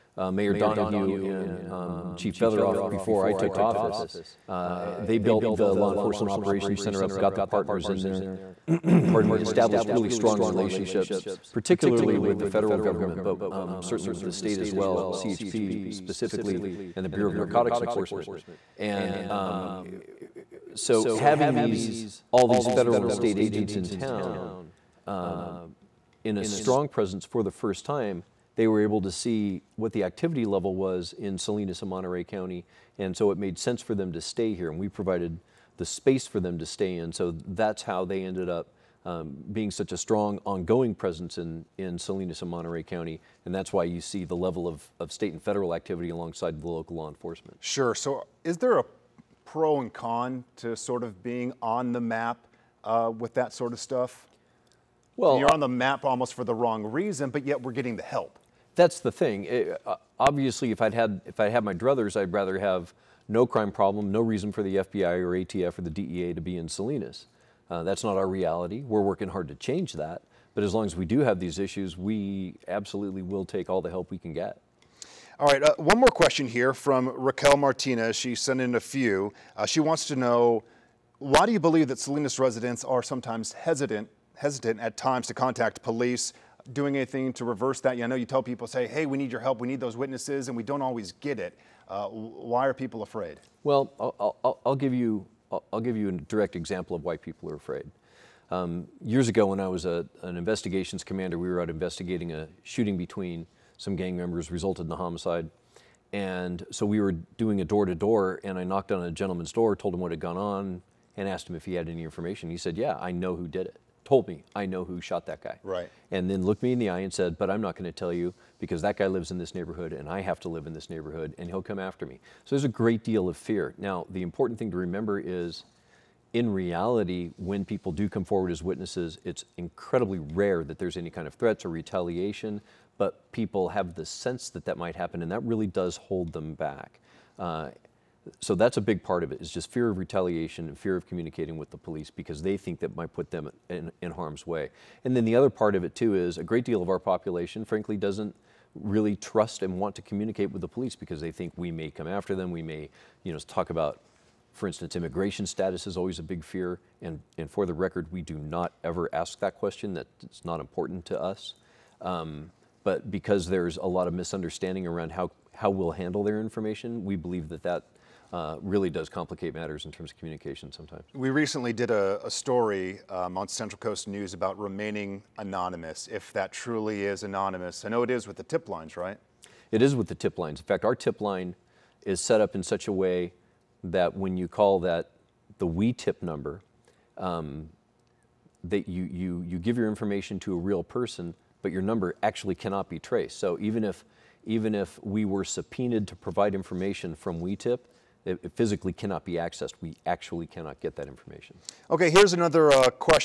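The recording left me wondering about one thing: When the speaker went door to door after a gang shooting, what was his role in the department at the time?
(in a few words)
investigations commander.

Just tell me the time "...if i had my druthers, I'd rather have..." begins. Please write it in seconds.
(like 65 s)
61 s.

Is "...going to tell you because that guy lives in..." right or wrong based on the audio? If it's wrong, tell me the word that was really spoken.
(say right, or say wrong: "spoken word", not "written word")
right.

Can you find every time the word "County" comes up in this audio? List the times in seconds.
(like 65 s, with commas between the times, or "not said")
32 s, 42 s.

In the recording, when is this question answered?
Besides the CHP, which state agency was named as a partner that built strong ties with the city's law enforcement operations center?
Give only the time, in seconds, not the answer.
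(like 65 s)
17 s.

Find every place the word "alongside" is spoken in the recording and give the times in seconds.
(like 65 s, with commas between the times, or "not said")
46 s.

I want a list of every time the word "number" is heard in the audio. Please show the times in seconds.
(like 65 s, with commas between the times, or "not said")
186 s, 191 s.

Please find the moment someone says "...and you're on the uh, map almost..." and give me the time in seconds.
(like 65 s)
55 s.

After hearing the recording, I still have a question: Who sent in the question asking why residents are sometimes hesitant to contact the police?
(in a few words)
Raquel Martinez.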